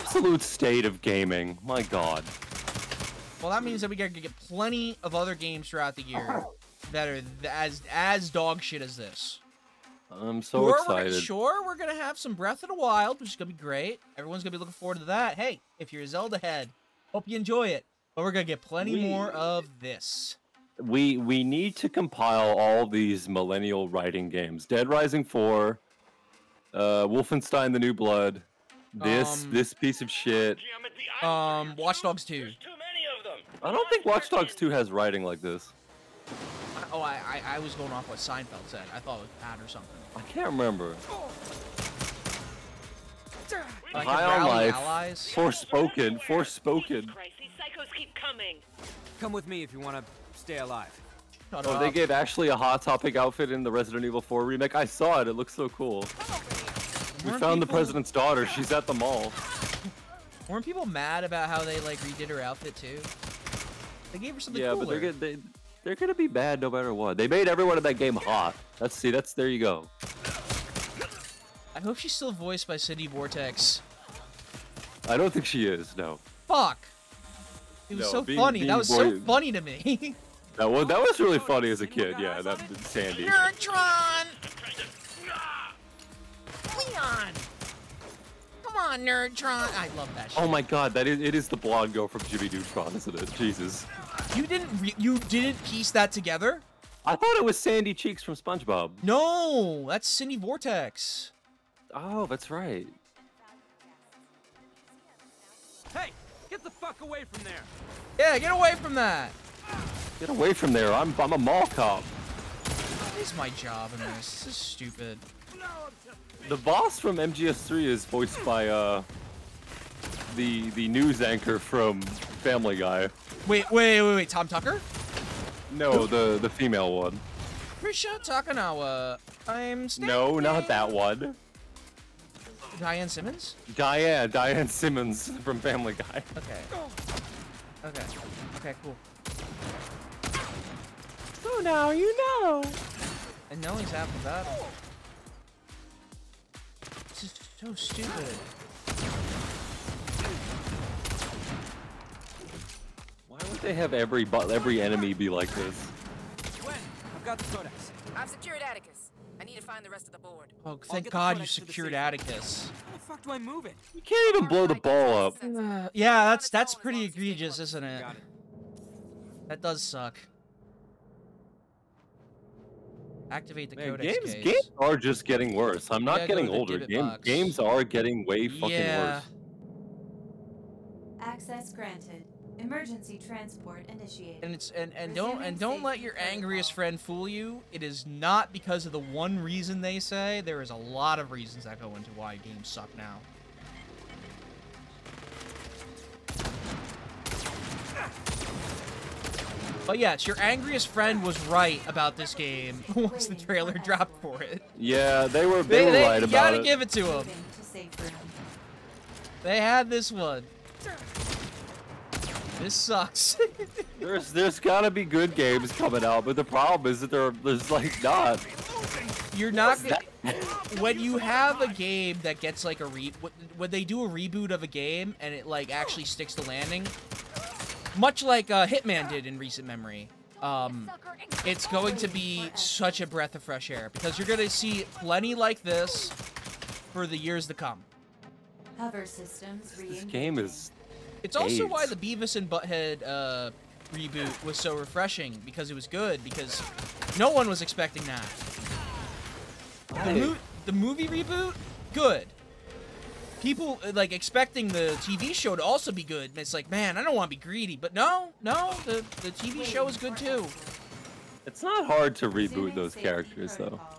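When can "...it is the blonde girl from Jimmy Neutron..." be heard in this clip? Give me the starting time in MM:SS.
01:31.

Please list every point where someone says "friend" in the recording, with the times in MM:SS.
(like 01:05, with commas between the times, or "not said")
03:06, 03:20.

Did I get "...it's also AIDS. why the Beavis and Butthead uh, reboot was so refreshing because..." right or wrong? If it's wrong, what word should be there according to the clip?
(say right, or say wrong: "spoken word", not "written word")
right.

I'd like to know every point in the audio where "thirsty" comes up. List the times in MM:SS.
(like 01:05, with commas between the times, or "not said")
not said.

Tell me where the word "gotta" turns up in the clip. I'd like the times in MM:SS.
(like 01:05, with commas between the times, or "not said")
00:03, 03:26, 03:34.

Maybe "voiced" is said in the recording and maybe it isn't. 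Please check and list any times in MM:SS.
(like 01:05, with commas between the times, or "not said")
01:12, 01:58.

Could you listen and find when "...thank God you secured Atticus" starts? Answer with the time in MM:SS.
02:40.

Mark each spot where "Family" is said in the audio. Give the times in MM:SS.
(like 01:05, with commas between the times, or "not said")
02:02, 02:15.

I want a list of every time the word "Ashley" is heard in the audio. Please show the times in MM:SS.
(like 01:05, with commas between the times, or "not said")
00:52.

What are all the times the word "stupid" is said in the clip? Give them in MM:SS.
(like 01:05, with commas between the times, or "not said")
01:54, 02:27.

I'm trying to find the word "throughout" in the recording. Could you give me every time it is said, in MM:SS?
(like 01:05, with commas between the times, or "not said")
00:05.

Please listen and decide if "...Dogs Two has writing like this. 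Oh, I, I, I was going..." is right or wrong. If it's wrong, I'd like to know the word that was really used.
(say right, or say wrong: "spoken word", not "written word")
right.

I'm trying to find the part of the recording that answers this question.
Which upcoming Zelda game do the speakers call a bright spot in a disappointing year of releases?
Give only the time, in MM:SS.
00:12.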